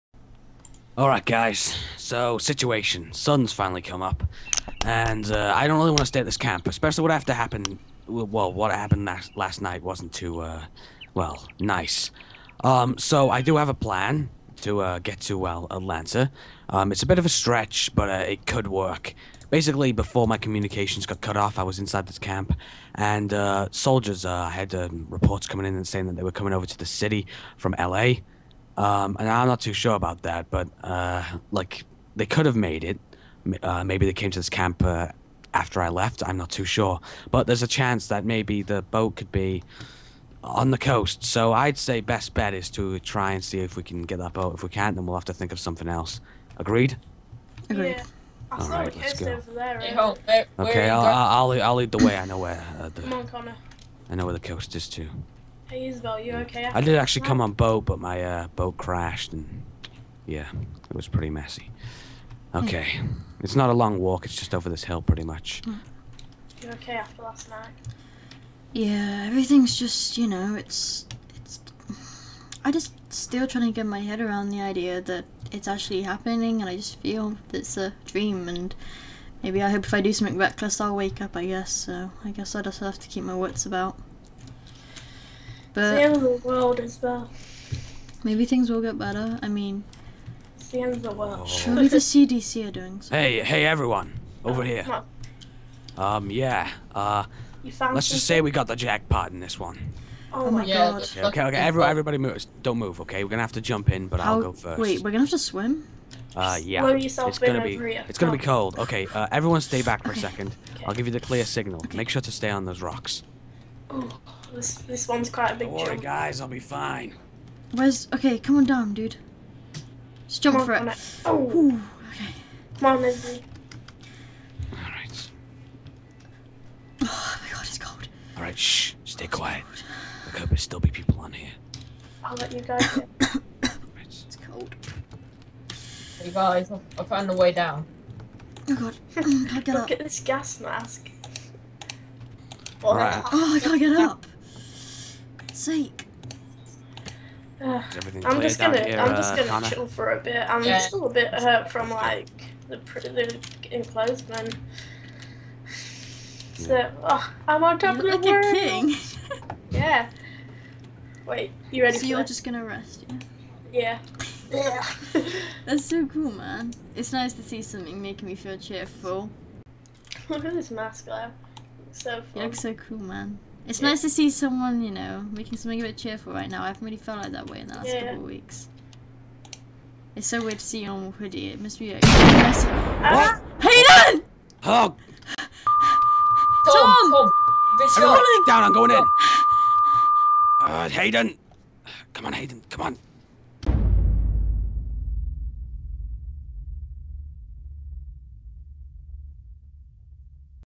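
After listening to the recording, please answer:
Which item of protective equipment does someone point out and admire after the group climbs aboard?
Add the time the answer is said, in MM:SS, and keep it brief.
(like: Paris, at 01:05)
gas mask, at 02:20.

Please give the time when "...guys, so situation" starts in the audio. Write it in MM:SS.
00:01.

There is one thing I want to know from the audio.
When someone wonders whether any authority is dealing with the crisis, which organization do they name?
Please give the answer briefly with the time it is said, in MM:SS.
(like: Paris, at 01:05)
CDC, at 01:31.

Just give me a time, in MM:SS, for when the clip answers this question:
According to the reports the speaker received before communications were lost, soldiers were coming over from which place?
00:27.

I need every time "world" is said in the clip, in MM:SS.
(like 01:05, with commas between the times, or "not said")
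01:26, 01:31, 02:38.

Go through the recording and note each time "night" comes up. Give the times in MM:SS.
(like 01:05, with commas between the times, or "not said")
00:09, 01:07.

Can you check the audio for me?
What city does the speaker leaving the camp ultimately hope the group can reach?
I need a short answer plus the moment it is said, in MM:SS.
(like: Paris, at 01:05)
Atlanta, at 00:15.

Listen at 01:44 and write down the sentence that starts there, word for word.
Wait, we're gonna have to swim?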